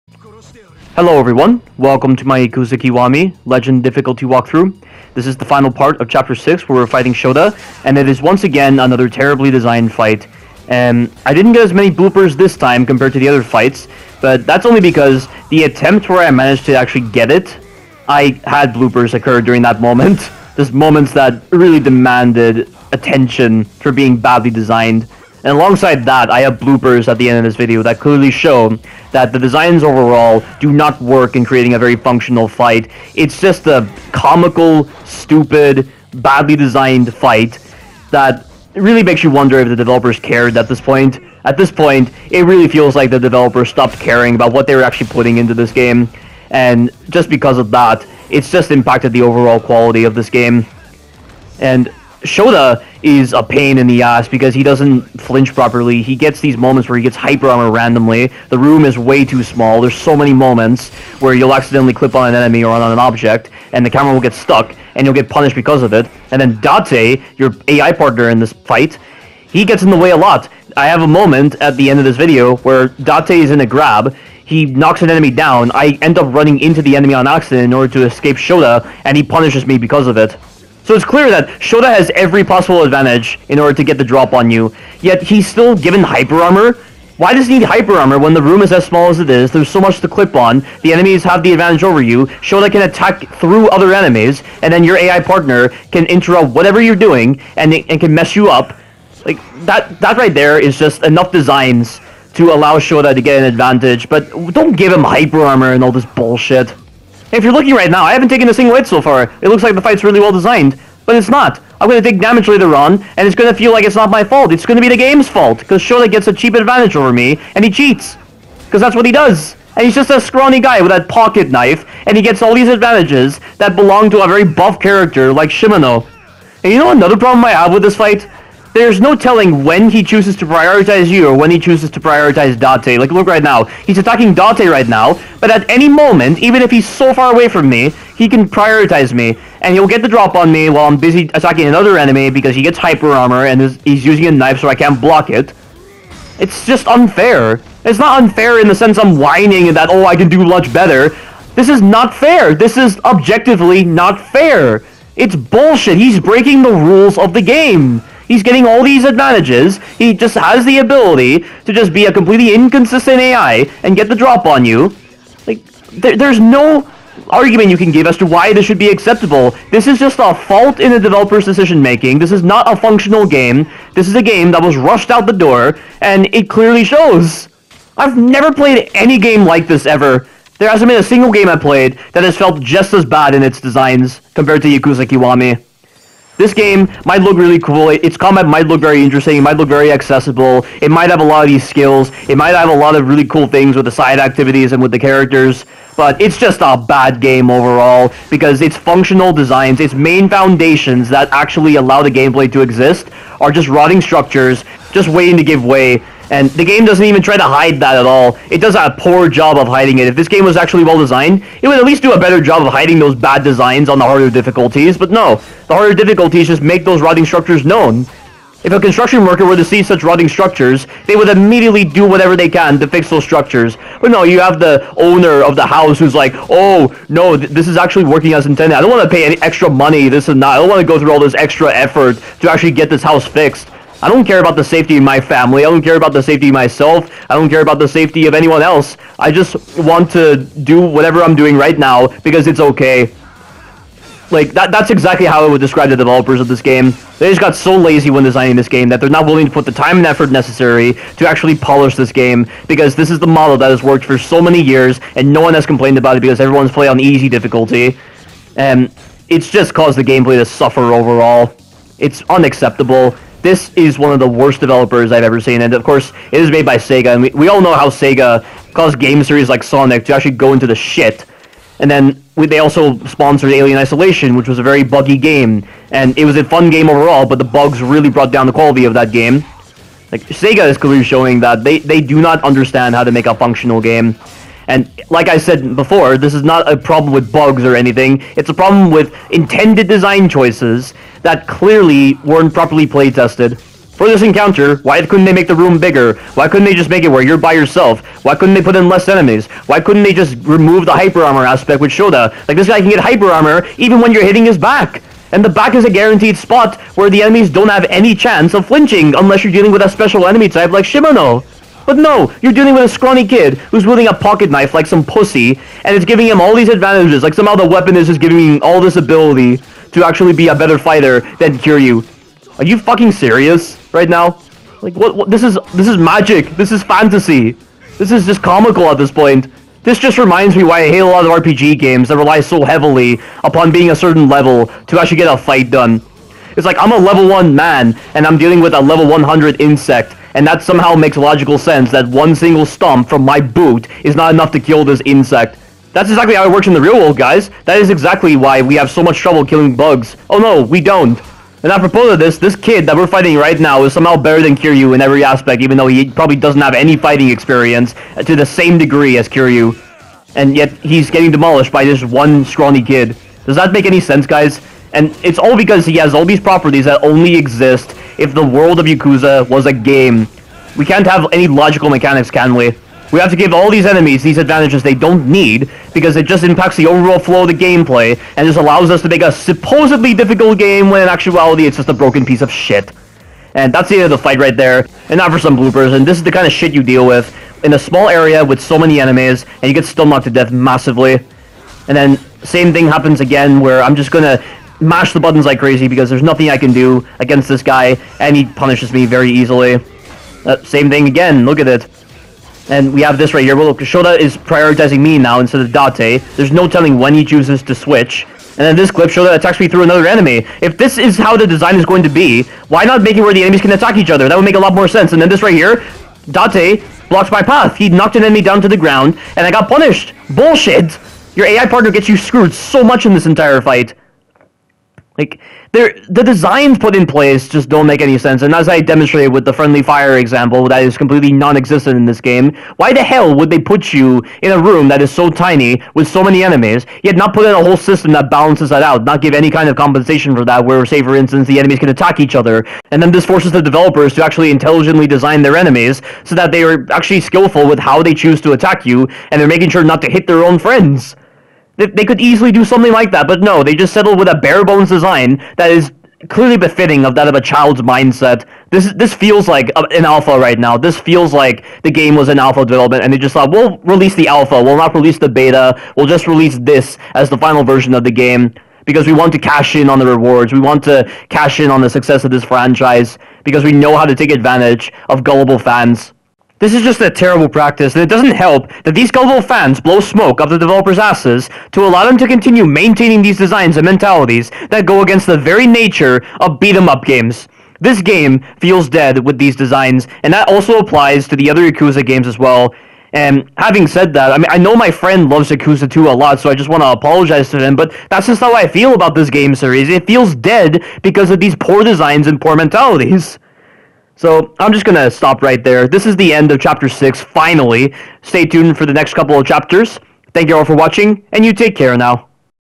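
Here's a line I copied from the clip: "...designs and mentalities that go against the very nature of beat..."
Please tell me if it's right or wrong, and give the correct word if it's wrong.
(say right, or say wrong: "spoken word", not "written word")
right.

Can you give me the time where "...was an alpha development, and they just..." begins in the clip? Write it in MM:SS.
07:42.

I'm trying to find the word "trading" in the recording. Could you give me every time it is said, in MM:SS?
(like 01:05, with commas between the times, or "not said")
not said.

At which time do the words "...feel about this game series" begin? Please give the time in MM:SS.
08:18.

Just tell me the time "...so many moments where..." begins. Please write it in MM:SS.
00:59.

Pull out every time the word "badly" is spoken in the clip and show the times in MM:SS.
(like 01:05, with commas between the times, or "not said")
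00:24, 00:36.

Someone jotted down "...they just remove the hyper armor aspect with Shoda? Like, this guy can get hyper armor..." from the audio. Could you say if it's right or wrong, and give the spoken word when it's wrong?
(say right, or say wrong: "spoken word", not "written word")
right.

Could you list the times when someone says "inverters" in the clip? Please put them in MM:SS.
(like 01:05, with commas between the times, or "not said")
not said.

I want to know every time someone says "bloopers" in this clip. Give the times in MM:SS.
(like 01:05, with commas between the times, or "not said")
00:11, 00:18, 00:26, 06:25.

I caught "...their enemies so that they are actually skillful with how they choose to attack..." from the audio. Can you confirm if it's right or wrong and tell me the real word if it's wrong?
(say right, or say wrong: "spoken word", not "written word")
right.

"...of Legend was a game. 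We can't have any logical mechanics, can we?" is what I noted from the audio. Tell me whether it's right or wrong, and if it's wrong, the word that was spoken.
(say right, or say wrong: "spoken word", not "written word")
wrong: "Yakuza", not "Legend".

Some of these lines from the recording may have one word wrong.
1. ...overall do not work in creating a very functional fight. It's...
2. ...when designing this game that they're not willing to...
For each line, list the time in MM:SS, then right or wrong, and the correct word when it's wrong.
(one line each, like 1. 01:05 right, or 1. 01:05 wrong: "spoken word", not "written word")
1. 00:29 right
2. 04:08 right.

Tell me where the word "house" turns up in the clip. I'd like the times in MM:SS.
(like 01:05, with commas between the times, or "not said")
03:45, 03:53.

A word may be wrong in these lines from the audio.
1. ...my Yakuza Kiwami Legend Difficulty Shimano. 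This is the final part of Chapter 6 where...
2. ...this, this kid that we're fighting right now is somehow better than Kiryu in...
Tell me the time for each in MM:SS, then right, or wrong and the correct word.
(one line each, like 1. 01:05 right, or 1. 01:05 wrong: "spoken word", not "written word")
1. 00:02 wrong: "Walkthrough", not "Shimano"
2. 05:52 right.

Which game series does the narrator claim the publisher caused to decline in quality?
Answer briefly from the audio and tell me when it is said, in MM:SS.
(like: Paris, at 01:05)
Sonic, at 04:29.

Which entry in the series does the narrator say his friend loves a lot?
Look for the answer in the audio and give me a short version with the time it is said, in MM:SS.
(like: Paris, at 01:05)
Yakuza 2, at 08:15.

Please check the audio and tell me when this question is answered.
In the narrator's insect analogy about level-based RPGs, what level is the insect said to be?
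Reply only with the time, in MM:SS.
05:38.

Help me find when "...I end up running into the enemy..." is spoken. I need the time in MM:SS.
01:15.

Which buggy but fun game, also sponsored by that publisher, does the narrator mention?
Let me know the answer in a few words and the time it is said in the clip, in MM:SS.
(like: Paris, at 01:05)
Alien Isolation, at 04:33.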